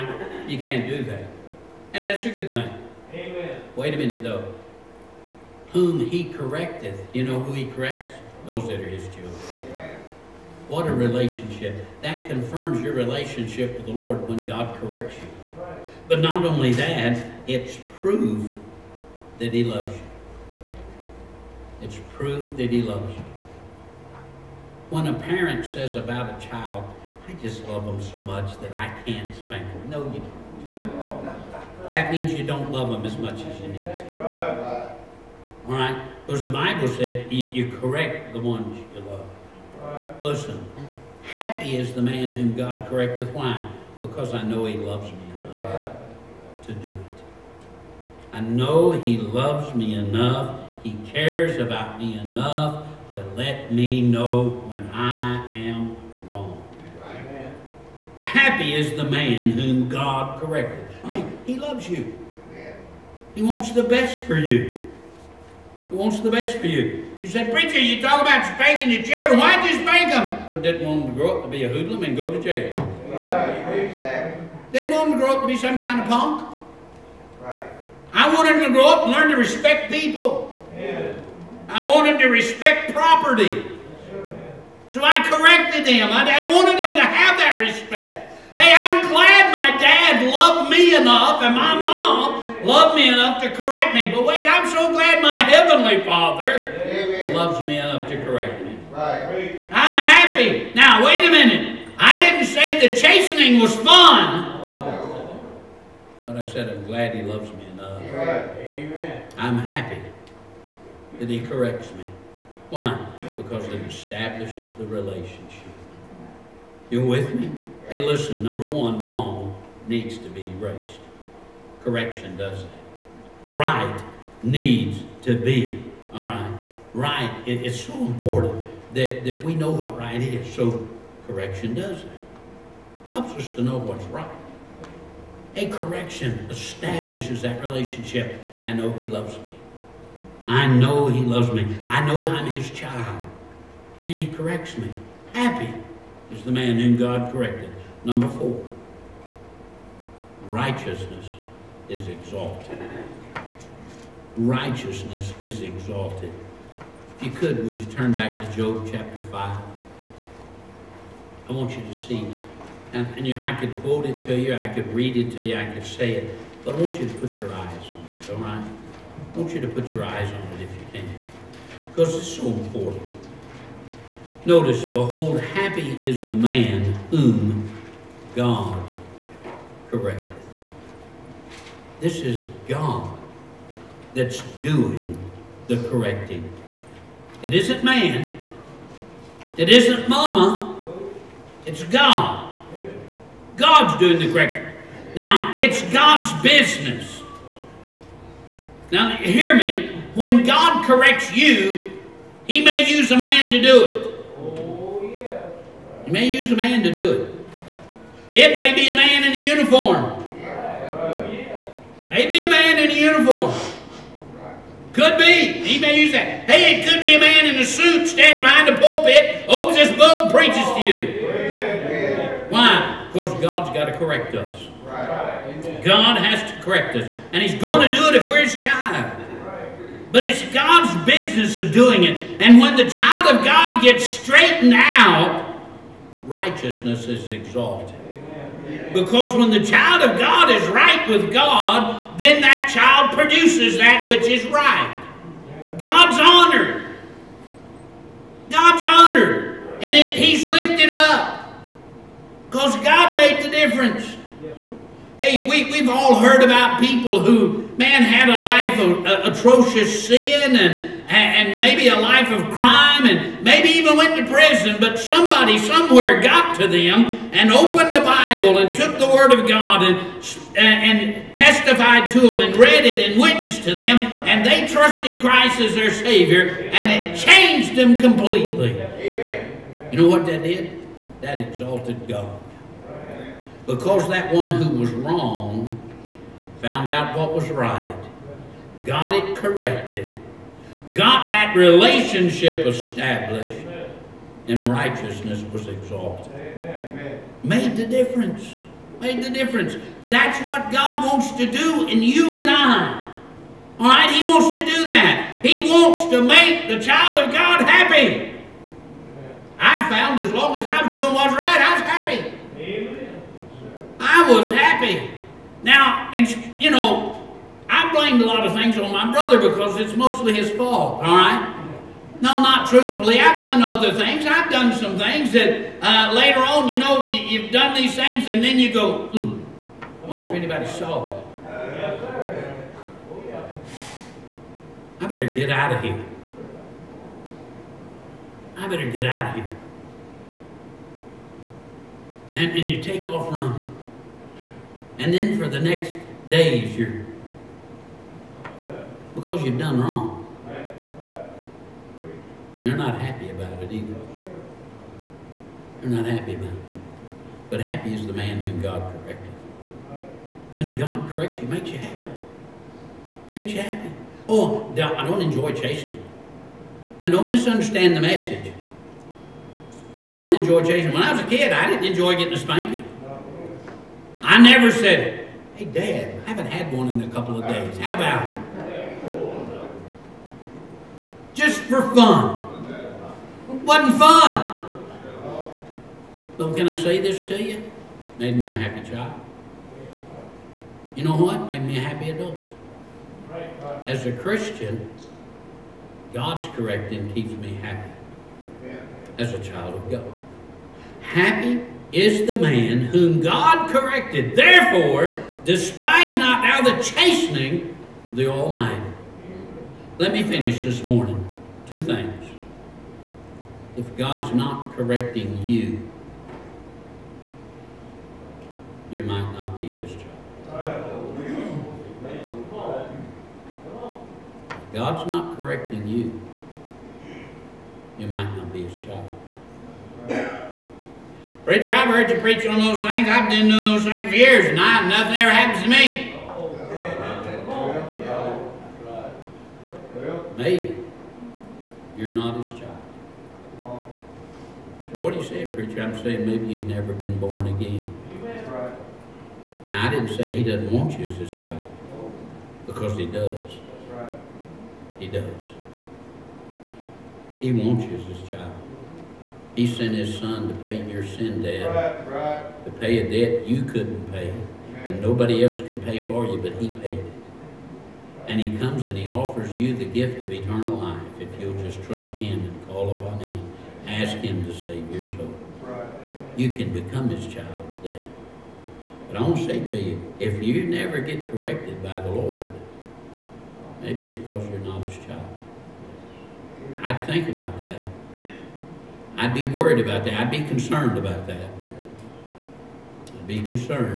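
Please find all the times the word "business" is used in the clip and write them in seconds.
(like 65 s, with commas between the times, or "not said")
196 s, 231 s.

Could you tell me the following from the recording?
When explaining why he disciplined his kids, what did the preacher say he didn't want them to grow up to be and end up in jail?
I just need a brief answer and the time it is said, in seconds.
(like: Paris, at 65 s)
A hoodlum, at 71 s.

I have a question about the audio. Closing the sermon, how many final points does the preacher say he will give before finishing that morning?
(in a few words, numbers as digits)
2.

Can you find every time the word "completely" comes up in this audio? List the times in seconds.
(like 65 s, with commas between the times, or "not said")
277 s.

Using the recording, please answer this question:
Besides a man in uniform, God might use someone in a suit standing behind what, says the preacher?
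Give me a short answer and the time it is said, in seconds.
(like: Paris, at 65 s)
The pulpit, at 218 s.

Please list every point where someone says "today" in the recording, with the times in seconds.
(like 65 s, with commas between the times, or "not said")
477 s.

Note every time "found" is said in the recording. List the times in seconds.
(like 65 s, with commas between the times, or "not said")
286 s, 309 s.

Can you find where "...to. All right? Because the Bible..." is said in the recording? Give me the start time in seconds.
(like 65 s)
33 s.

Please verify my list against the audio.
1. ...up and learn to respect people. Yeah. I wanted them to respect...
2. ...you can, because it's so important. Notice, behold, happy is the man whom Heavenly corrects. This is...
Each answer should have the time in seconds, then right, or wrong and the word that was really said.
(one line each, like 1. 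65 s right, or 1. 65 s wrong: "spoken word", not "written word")
1. 78 s right
2. 170 s wrong: "God", not "Heavenly".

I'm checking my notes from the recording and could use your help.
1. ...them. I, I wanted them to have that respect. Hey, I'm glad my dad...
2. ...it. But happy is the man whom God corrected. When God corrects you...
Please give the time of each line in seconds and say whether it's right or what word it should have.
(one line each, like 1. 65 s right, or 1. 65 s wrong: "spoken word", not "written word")
1. 85 s right
2. 356 s right.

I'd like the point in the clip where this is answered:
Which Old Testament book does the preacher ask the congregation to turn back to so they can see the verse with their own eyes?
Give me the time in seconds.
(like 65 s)
158 s.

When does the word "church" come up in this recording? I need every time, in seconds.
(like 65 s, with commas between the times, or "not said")
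not said.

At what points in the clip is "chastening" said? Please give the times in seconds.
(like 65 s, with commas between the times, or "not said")
102 s, 365 s, 370 s, 406 s.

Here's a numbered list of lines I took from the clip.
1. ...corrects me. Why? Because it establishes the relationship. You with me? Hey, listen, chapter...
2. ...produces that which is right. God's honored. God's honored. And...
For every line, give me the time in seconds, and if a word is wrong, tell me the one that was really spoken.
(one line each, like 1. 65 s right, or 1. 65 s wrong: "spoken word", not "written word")
1. 111 s wrong: "number", not "chapter"
2. 243 s right.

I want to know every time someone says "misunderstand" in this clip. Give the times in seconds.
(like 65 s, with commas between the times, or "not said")
367 s.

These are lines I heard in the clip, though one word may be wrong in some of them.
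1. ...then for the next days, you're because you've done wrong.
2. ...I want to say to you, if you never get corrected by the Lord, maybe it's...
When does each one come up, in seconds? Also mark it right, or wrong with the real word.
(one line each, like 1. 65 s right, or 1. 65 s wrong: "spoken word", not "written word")
1. 345 s right
2. 479 s right.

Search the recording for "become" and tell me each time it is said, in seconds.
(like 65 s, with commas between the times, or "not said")
476 s.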